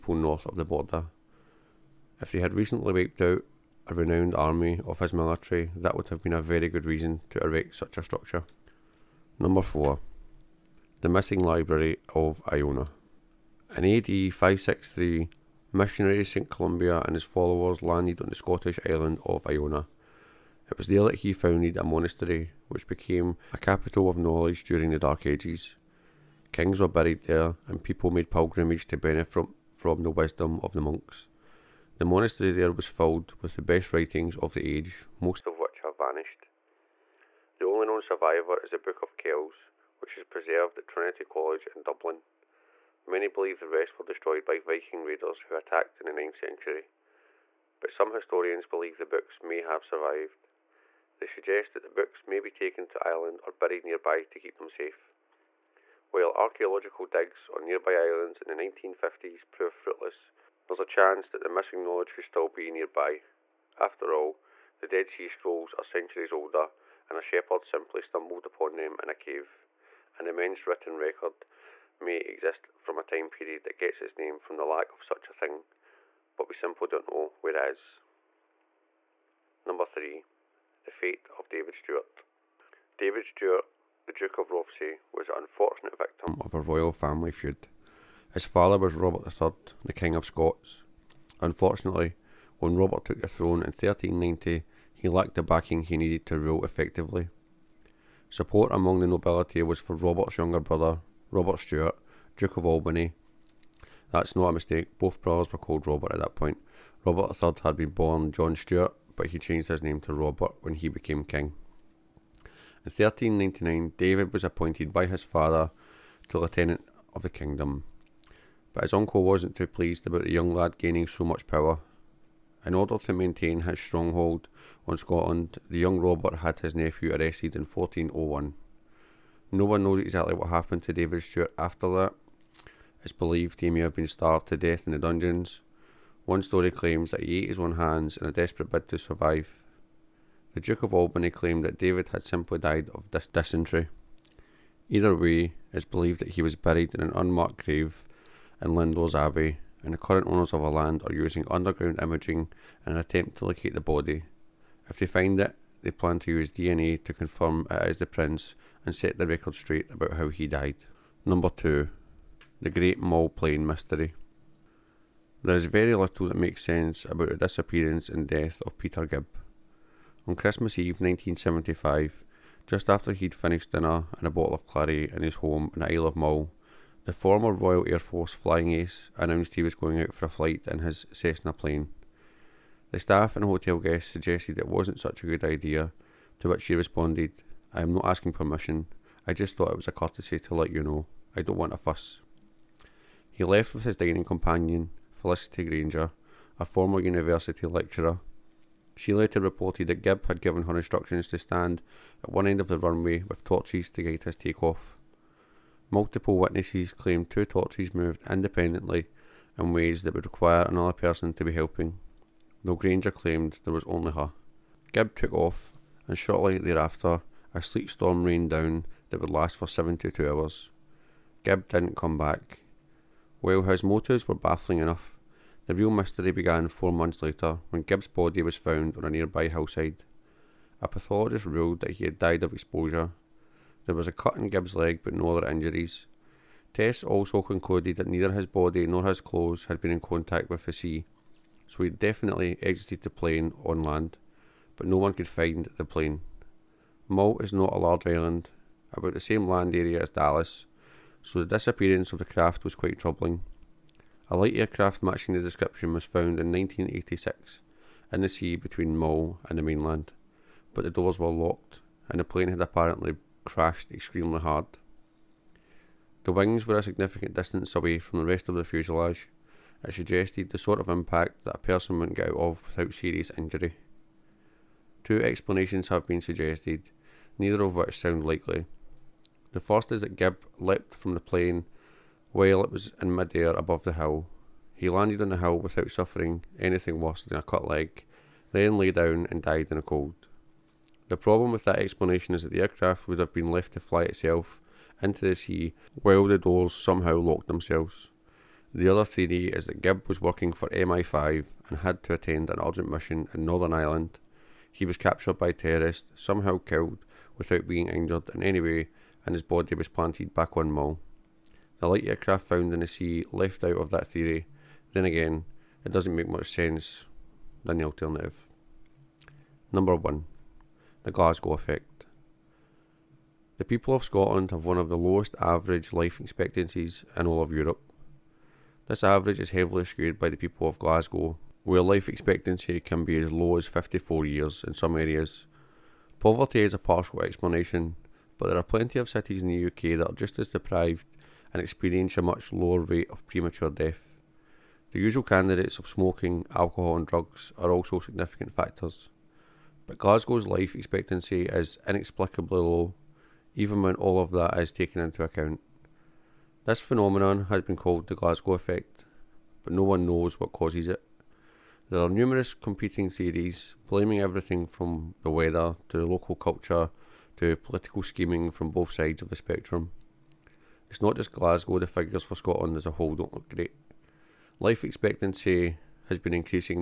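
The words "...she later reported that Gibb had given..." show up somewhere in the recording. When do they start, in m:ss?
3:19.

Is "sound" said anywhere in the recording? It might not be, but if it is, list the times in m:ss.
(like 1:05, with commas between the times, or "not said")
4:37.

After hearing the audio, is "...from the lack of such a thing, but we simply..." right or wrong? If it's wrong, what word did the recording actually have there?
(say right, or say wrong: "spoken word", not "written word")
right.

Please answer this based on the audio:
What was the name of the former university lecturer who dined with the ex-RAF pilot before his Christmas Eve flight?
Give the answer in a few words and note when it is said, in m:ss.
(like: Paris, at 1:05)
Felicity Grainger, at 3:15.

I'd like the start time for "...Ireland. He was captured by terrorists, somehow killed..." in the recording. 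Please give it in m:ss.
5:03.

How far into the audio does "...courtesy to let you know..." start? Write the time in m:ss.
3:09.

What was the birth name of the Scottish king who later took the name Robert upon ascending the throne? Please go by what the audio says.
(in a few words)
John Stuart.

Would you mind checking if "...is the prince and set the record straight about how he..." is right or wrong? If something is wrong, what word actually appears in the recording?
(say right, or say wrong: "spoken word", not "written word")
right.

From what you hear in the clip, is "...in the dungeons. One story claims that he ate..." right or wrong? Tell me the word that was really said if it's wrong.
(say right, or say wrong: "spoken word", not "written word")
right.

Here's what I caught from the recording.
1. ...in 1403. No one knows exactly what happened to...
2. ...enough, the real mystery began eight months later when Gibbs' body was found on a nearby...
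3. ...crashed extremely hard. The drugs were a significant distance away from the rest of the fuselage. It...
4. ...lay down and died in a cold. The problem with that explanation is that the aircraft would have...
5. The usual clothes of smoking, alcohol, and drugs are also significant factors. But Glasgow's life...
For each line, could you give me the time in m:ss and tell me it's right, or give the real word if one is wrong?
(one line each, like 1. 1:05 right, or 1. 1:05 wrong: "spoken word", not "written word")
1. 2:07 wrong: "1401", not "1403"
2. 3:44 wrong: "four", not "eight"
3. 4:23 wrong: "wings", not "drugs"
4. 4:48 right
5. 5:44 wrong: "candidates", not "clothes".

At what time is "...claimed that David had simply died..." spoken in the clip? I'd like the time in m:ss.
2:21.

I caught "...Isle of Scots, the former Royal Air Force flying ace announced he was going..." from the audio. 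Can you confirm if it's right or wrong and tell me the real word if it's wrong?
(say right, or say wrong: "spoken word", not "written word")
wrong: "Mull", not "Scots".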